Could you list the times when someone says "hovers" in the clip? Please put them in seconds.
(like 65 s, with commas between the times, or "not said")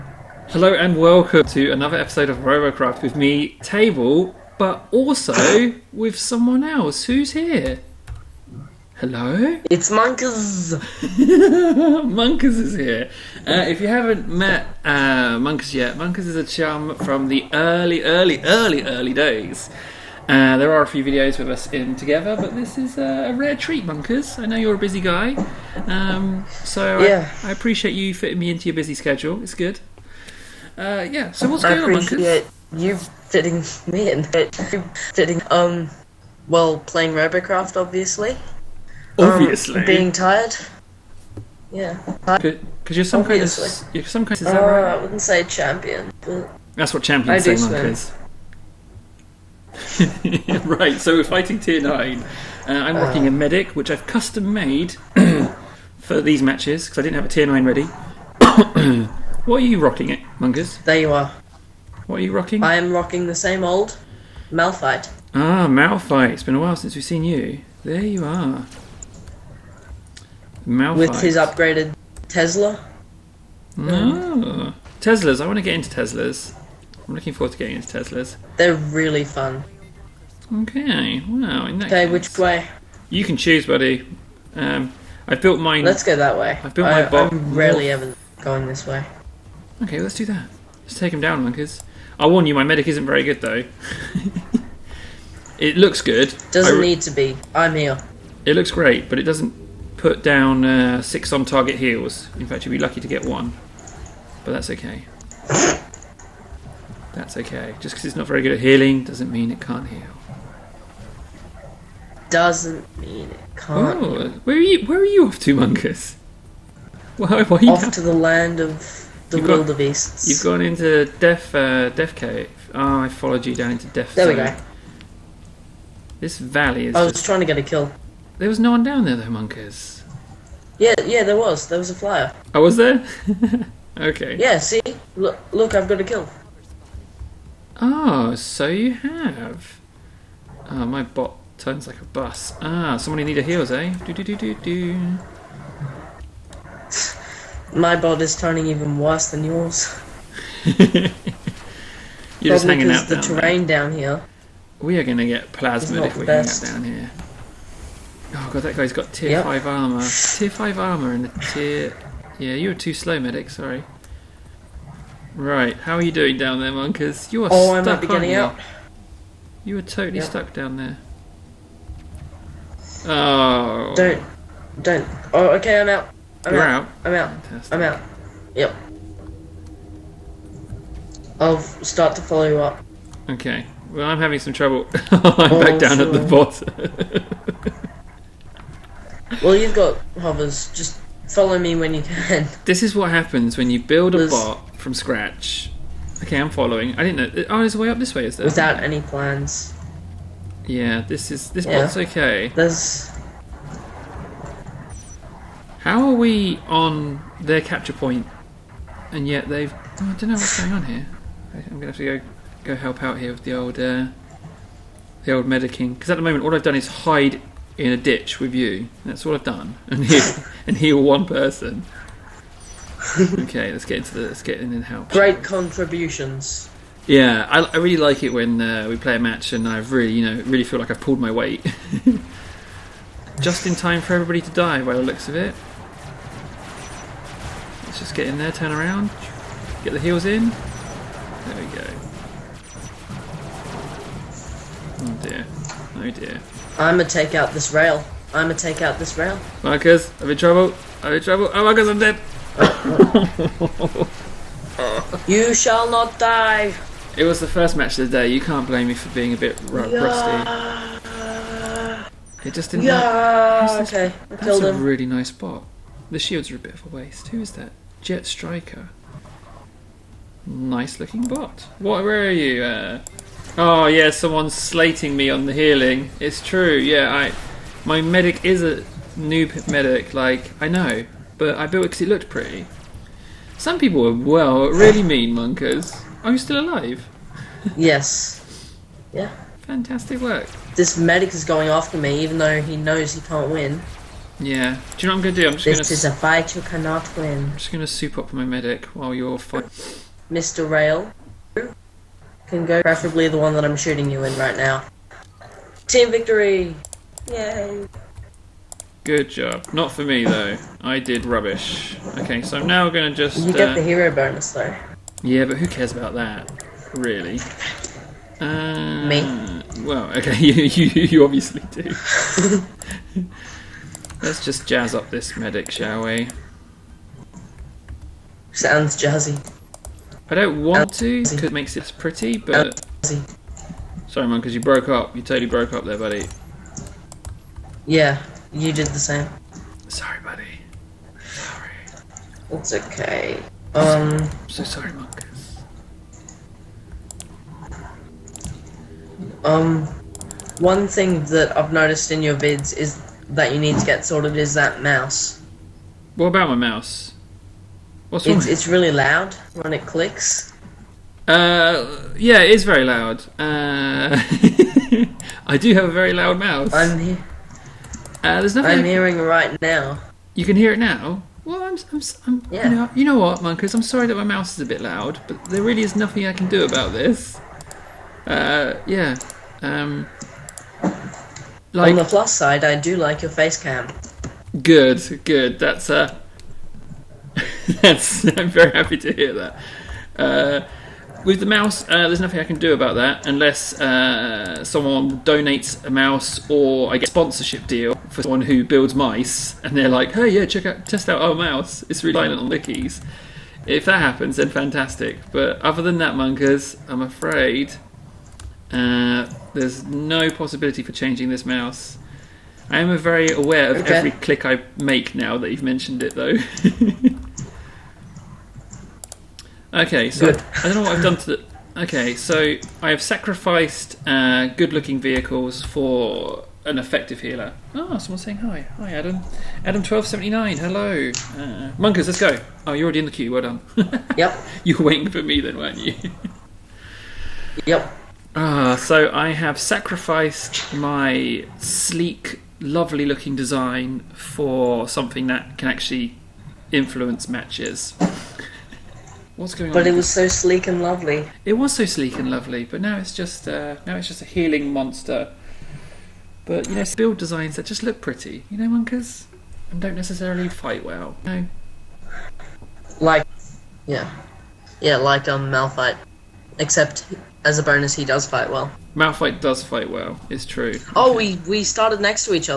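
190 s.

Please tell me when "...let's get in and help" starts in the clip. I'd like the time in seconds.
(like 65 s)
224 s.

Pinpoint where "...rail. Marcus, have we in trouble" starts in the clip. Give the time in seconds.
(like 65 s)
249 s.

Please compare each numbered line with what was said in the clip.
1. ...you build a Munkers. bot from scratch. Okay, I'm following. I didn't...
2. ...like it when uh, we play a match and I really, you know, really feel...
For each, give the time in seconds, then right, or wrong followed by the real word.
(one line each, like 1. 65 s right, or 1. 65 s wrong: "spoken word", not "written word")
1. 193 s wrong: "Liz", not "Munkers"
2. 227 s right.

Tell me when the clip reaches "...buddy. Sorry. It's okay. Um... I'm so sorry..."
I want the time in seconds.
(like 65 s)
340 s.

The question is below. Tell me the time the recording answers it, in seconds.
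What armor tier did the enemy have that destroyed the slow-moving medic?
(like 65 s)
160 s.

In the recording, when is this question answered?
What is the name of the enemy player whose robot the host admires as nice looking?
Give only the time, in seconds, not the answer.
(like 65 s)
268 s.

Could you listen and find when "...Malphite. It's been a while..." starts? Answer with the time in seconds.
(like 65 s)
65 s.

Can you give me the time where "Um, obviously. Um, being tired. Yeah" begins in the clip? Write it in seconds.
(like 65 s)
39 s.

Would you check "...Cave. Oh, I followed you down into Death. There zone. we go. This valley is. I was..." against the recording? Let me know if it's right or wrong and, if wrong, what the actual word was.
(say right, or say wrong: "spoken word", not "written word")
right.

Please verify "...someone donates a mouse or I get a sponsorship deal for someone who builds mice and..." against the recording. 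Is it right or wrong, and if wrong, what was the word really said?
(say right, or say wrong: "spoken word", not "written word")
right.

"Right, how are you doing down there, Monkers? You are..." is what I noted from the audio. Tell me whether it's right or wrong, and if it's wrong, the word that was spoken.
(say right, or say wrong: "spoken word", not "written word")
right.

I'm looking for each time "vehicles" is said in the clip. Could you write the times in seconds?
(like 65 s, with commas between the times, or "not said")
424 s.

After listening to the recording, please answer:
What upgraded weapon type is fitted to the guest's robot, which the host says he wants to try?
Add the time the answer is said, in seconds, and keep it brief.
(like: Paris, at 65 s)
Tesla, at 71 s.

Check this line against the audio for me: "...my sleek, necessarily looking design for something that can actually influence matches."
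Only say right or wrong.
wrong.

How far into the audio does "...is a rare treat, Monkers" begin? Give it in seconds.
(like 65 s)
22 s.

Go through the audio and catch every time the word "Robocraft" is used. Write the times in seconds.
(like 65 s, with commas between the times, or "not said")
2 s, 37 s.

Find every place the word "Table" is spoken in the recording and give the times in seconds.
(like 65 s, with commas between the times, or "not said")
3 s.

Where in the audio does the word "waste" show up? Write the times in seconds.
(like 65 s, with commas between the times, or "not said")
266 s.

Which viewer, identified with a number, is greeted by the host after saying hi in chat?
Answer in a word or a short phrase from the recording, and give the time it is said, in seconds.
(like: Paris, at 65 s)
Adam 1279, at 429 s.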